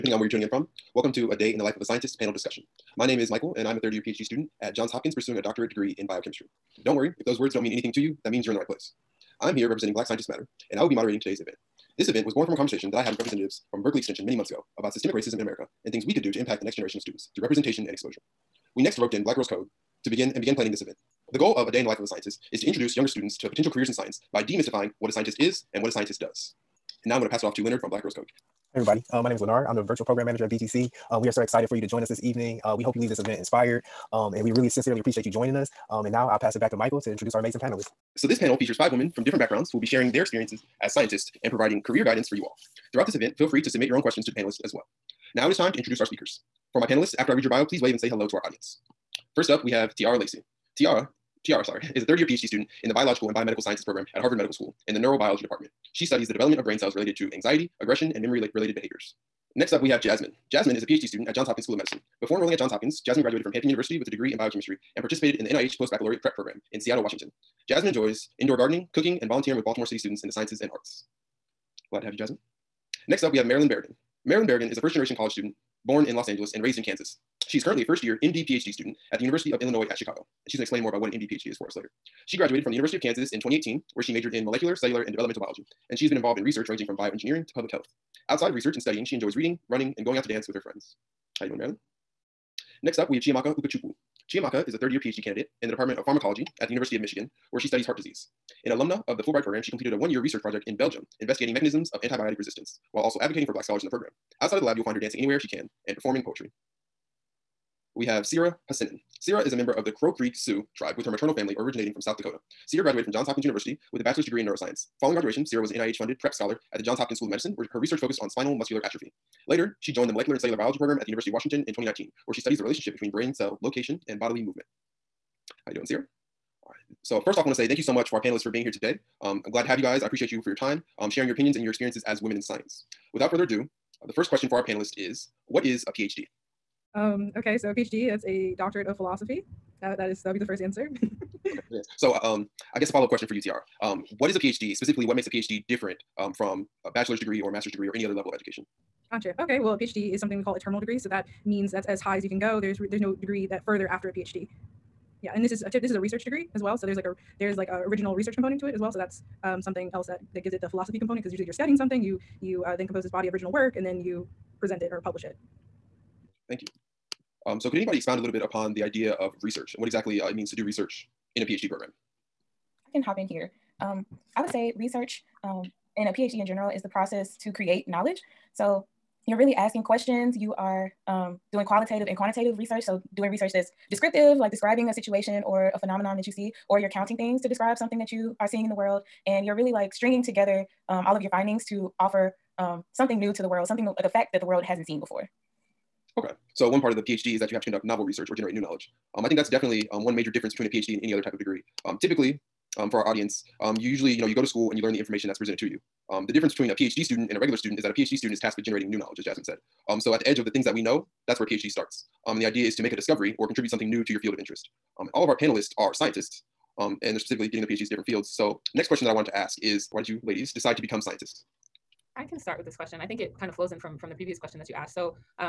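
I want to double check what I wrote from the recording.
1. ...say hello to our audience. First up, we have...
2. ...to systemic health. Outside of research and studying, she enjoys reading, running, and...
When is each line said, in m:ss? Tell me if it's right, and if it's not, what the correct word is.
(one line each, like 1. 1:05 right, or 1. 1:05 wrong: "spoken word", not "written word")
1. 0:47 right
2. 1:27 wrong: "public", not "systemic".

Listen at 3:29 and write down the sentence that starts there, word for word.
Um, so at the edge of the things that we know, that's where PhD starts.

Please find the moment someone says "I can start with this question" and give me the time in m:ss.
3:42.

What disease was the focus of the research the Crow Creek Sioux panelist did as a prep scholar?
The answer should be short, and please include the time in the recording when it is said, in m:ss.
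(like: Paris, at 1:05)
spinal muscular atrophy, at 1:58.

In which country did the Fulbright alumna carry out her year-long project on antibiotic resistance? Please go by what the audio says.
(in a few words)
Belgium.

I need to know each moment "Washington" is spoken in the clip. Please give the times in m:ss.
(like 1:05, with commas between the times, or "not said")
1:07, 2:01.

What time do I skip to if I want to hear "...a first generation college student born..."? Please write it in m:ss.
1:14.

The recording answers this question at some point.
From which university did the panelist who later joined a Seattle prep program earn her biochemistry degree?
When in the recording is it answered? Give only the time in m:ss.
1:03.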